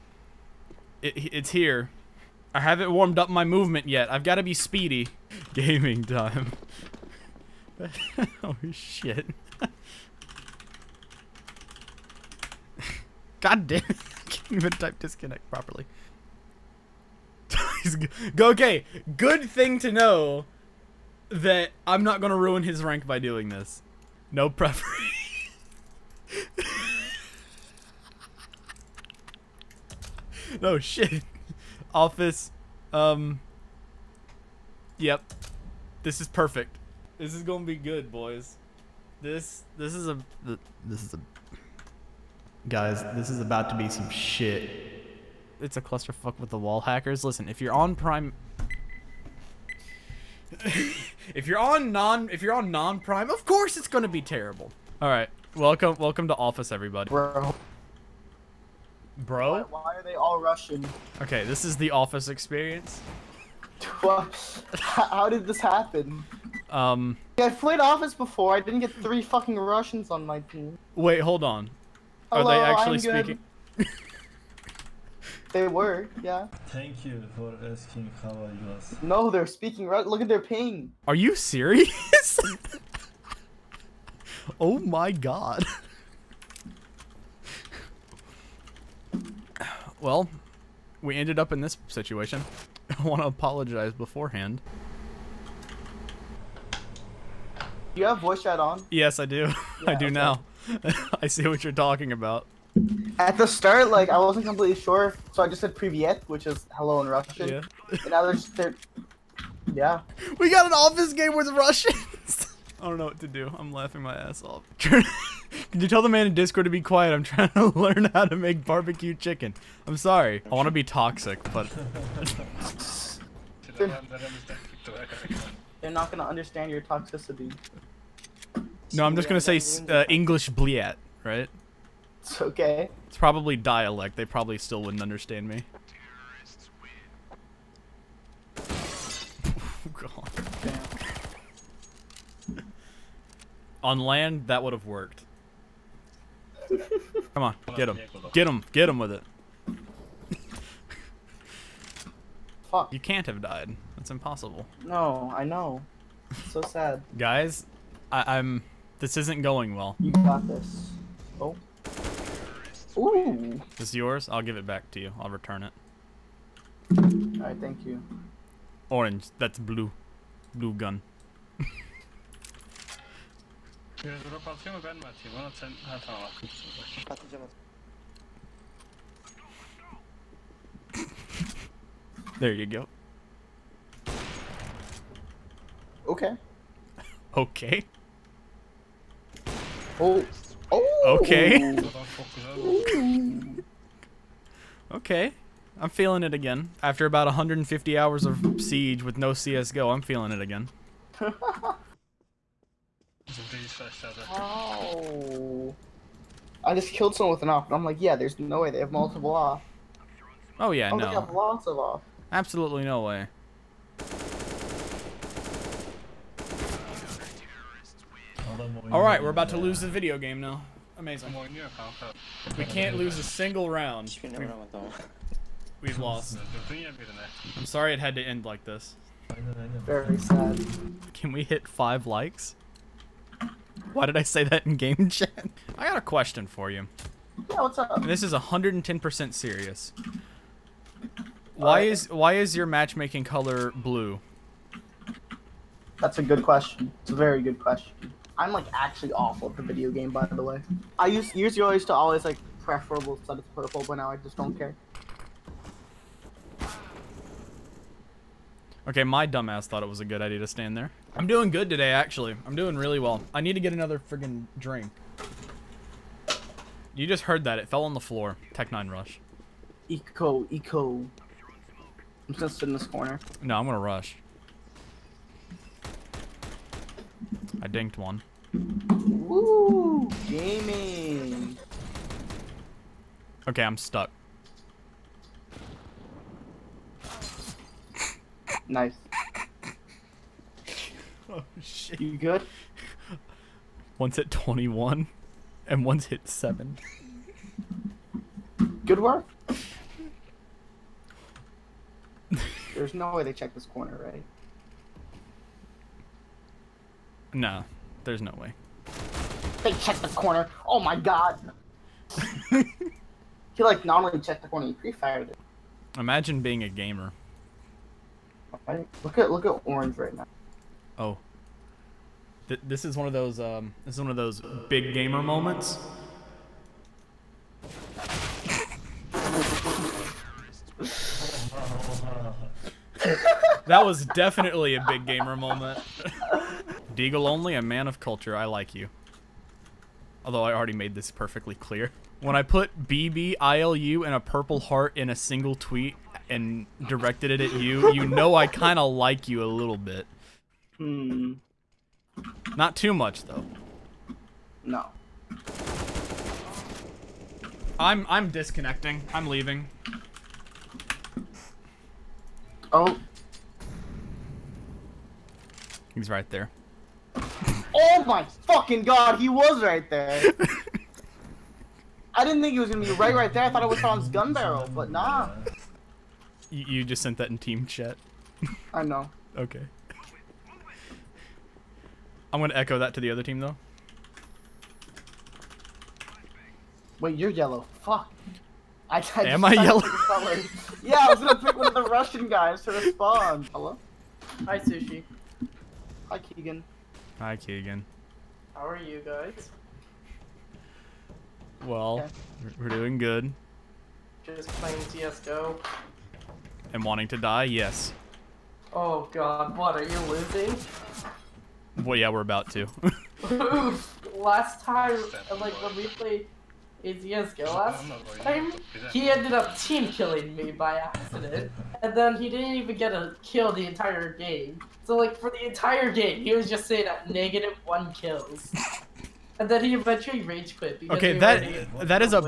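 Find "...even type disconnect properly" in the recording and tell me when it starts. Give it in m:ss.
0:14.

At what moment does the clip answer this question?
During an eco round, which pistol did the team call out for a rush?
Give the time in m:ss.
4:28.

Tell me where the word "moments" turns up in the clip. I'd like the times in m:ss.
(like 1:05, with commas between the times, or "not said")
5:25, 5:35.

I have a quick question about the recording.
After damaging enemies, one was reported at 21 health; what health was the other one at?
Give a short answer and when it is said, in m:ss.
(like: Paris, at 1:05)
7, at 4:56.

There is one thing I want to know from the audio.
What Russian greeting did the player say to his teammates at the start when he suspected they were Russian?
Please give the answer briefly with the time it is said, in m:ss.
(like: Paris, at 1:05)
privyet, at 1:45.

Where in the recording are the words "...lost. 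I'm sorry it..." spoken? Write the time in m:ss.
3:45.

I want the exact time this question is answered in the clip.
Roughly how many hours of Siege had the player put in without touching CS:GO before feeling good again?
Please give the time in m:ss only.
3:17.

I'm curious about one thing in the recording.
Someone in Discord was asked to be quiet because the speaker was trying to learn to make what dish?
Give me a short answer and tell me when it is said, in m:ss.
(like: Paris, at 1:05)
barbecue chicken, at 1:58.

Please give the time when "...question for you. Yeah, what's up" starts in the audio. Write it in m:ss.
3:56.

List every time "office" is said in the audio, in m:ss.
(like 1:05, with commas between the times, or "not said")
0:31, 0:56, 1:01, 1:07, 1:50.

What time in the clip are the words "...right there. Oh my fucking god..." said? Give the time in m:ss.
6:06.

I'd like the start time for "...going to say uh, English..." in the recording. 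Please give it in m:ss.
2:09.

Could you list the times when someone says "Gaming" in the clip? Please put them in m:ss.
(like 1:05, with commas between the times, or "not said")
0:05, 4:40.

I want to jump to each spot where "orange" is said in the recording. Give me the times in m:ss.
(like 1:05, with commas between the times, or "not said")
2:48, 5:19.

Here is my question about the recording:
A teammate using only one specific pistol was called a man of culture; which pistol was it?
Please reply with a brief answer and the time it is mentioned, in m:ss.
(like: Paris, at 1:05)
Deagle, at 5:36.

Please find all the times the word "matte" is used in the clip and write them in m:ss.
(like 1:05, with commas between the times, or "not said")
not said.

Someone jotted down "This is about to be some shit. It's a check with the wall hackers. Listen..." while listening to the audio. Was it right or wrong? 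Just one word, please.
wrong.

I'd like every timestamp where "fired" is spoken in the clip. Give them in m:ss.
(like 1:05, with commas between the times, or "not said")
5:14.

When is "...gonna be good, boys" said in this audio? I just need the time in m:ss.
0:37.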